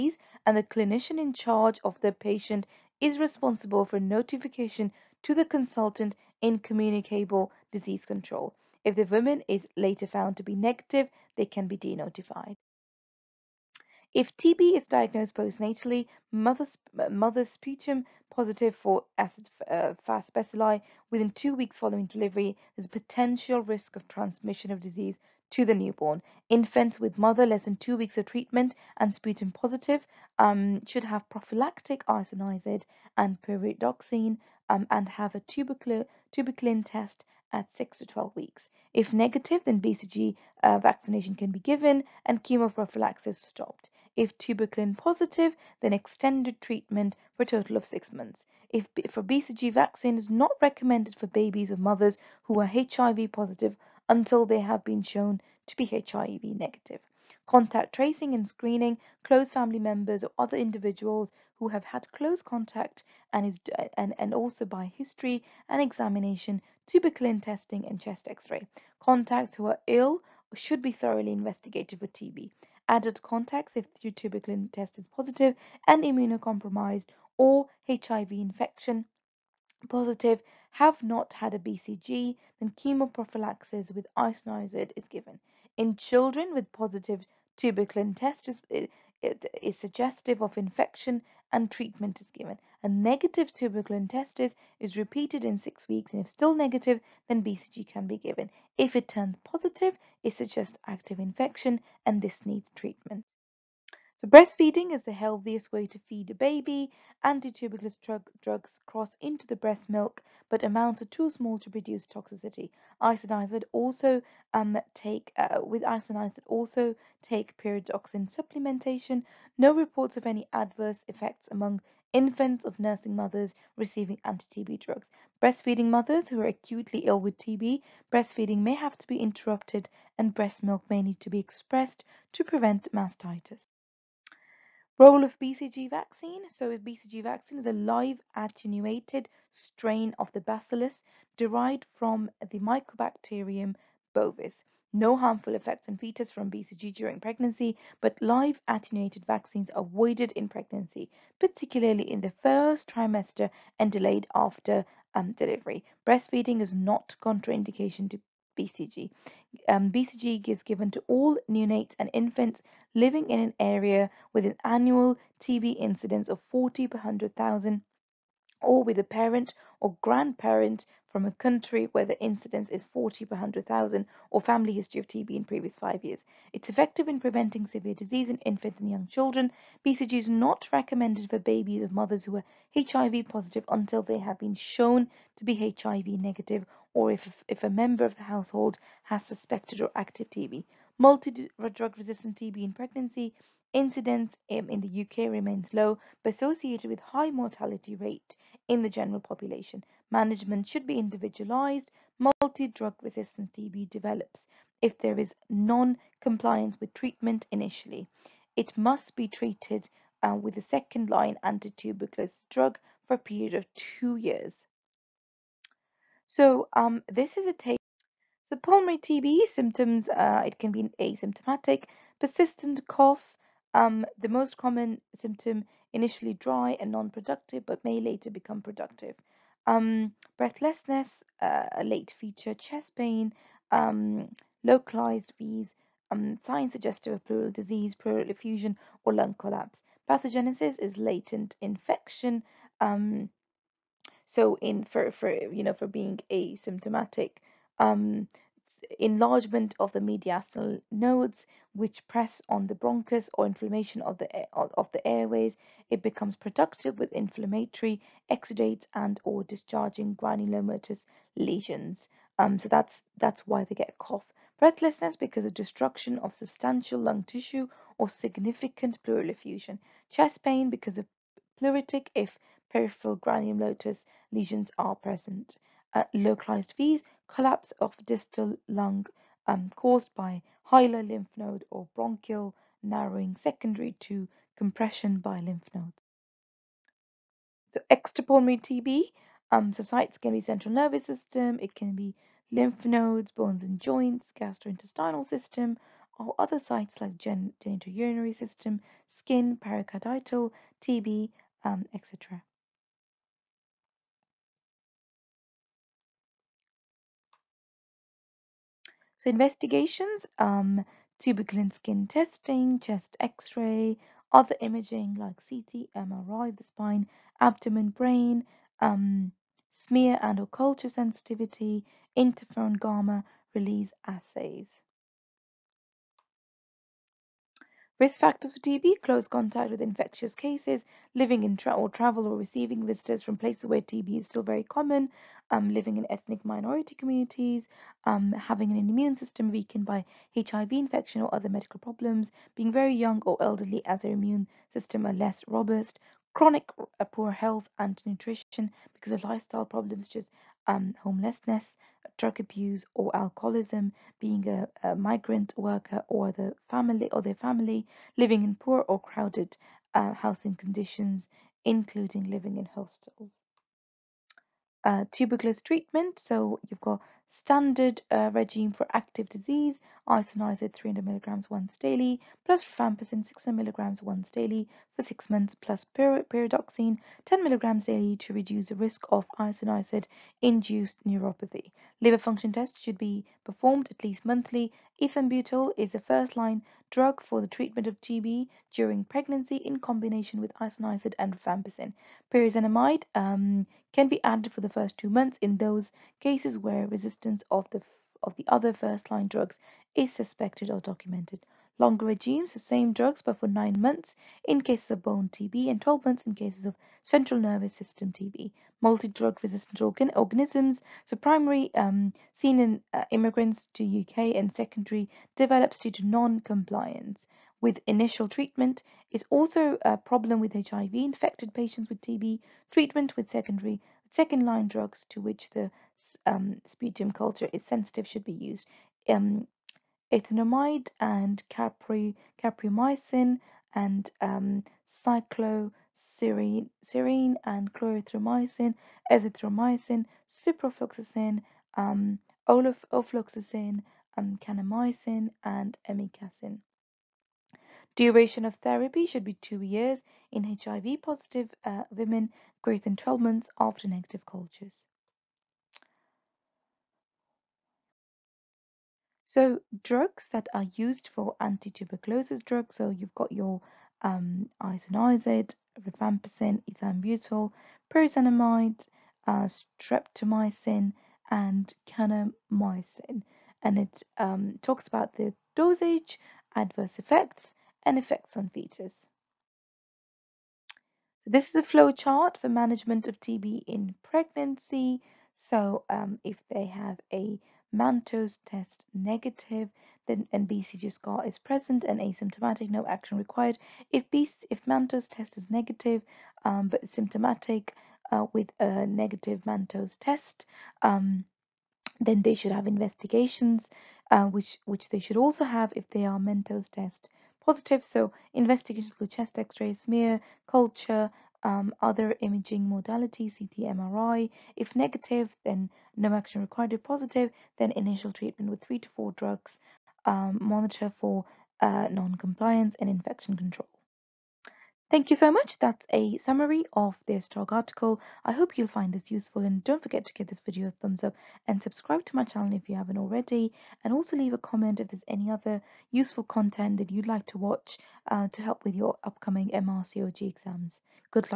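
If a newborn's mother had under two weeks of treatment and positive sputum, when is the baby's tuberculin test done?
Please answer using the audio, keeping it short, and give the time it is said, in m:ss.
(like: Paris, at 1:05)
6 to 12 weeks, at 0:37.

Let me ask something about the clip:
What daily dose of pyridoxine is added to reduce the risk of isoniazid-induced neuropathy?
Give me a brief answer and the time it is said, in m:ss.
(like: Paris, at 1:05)
10 milligrams, at 6:17.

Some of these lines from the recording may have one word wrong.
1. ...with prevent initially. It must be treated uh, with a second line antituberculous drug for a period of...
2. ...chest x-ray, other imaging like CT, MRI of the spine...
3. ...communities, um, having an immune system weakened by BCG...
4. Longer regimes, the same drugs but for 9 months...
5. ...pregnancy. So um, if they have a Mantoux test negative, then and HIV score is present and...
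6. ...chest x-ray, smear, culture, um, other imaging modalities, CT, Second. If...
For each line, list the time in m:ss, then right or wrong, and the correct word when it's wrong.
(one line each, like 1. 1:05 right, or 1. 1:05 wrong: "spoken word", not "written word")
1. 3:26 wrong: "treatment", not "prevent"
2. 5:12 right
3. 5:36 wrong: "HIV", not "BCG"
4. 6:41 right
5. 8:04 wrong: "BCG", not "HIV"
6. 8:29 wrong: "MRI", not "Second".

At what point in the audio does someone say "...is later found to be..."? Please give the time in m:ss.
0:09.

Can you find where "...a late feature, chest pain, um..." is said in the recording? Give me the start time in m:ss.
3:51.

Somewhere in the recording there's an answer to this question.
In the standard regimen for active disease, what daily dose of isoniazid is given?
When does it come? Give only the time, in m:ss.
6:10.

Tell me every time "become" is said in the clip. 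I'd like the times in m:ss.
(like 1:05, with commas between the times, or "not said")
3:48, 4:16.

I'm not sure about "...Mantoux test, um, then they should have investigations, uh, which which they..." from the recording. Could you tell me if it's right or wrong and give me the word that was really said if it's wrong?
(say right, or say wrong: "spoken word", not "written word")
right.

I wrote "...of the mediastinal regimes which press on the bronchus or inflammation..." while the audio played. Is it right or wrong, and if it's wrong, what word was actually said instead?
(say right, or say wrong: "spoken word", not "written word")
wrong: "nodes", not "regimes".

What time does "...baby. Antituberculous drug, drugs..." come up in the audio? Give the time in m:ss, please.
1:46.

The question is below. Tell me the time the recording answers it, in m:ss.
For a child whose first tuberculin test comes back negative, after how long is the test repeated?
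1:35.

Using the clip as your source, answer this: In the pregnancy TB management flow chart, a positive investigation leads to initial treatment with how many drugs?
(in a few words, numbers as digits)
three to four.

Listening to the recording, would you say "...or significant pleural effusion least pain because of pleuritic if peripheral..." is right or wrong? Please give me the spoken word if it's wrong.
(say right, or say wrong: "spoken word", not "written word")
wrong: "chest", not "least".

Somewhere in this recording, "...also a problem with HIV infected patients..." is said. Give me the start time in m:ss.
6:59.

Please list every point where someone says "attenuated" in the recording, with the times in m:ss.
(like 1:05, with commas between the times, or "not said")
2:18, 2:28.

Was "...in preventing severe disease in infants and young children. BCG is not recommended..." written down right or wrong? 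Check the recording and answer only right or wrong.
right.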